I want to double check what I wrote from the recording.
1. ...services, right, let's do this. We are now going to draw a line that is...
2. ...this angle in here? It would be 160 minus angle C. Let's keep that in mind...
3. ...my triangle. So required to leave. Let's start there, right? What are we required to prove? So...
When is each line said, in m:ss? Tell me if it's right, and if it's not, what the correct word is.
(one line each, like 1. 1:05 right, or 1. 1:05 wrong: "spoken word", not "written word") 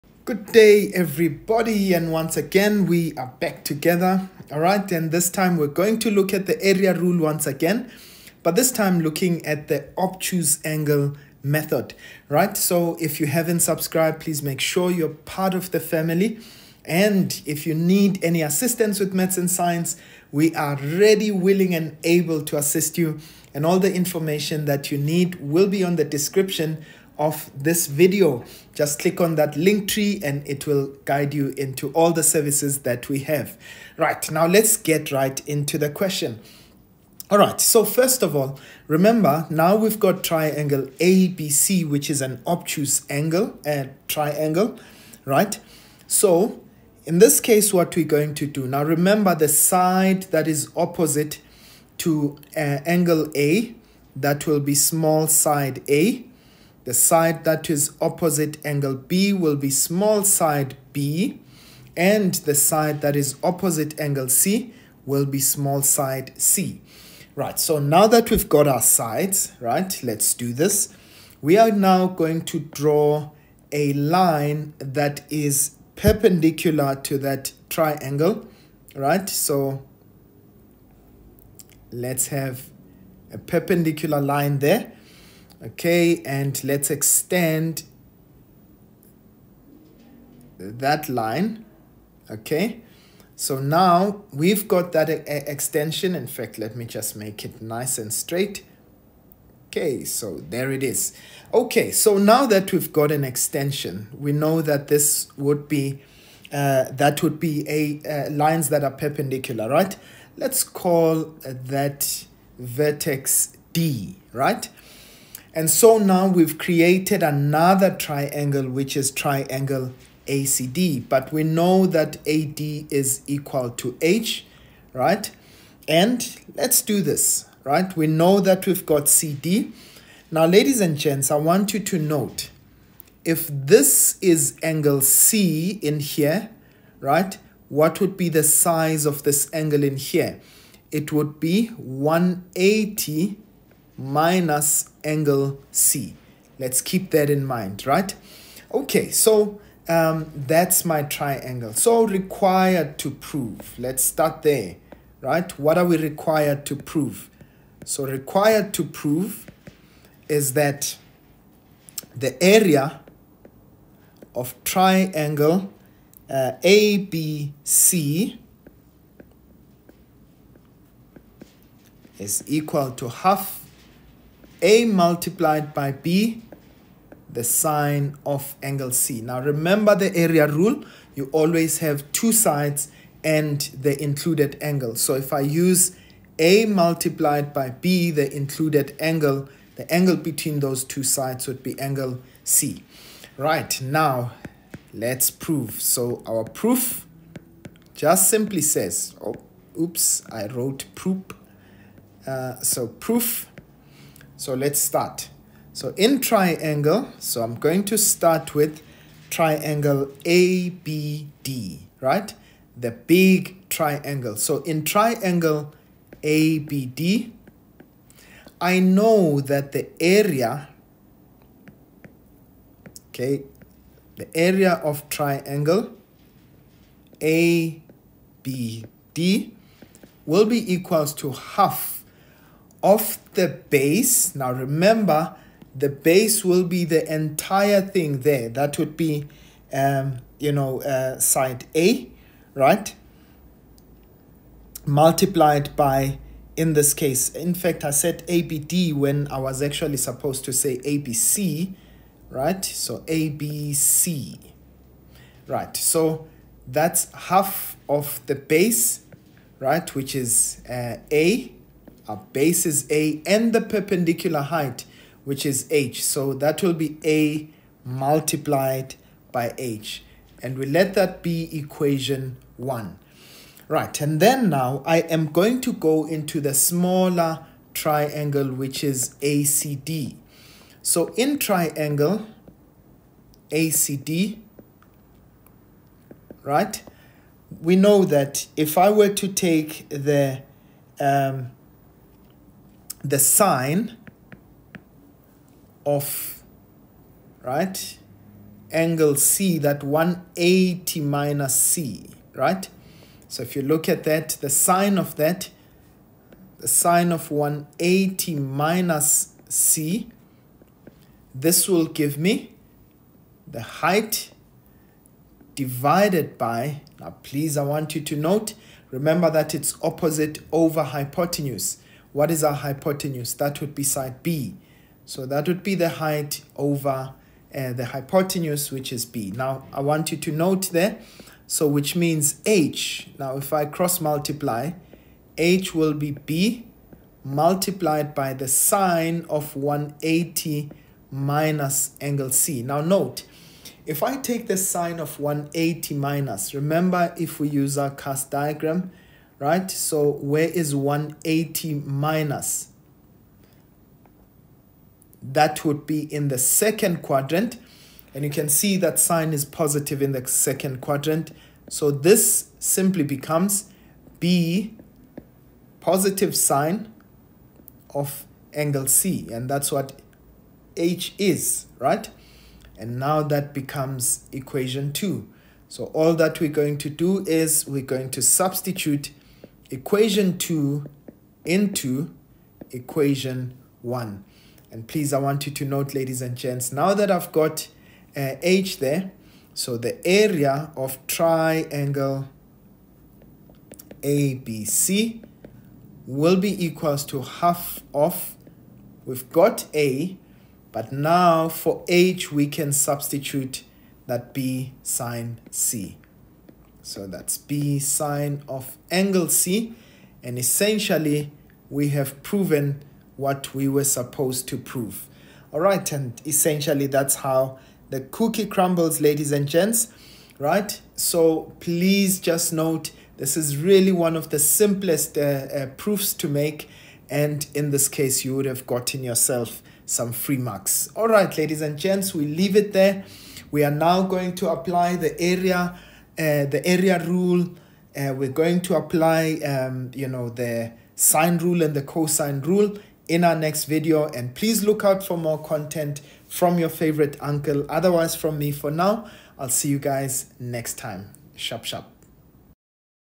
1. 1:08 wrong: "sides", not "services"
2. 2:19 wrong: "180", not "160"
3. 2:30 wrong: "prove", not "leave".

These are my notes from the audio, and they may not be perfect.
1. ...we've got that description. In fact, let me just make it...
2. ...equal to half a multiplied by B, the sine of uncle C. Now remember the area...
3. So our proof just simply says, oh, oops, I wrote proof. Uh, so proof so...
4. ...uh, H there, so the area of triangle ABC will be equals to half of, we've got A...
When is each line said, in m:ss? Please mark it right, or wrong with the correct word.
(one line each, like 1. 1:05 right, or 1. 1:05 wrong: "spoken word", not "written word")
1. 1:34 wrong: "extension", not "description"
2. 2:52 wrong: "angle", not "uncle"
3. 3:15 right
4. 6:28 right.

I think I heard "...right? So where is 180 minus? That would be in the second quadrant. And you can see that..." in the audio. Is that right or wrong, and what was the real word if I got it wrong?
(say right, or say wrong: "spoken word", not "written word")
right.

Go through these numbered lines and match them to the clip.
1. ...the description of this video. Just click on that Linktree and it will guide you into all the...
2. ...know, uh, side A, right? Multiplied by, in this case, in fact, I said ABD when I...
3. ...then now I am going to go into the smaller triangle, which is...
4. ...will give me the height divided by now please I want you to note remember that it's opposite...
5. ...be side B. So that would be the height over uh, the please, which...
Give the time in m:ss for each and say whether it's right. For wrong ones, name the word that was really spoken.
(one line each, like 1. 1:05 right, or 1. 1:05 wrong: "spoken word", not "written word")
1. 0:25 right
2. 4:00 right
3. 4:34 right
4. 5:11 right
5. 5:23 wrong: "hypotenuse", not "please".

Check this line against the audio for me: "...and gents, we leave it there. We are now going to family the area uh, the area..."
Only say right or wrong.
wrong.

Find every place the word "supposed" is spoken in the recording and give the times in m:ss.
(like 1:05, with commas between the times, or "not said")
4:09, 6:53.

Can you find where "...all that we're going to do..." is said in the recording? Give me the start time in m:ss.
6:15.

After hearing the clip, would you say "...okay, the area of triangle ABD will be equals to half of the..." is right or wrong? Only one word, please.
right.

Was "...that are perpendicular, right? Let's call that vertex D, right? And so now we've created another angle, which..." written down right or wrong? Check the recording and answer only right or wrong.
wrong.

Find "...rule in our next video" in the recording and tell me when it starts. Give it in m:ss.
7:22.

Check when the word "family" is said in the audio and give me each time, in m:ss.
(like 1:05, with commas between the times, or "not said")
0:15.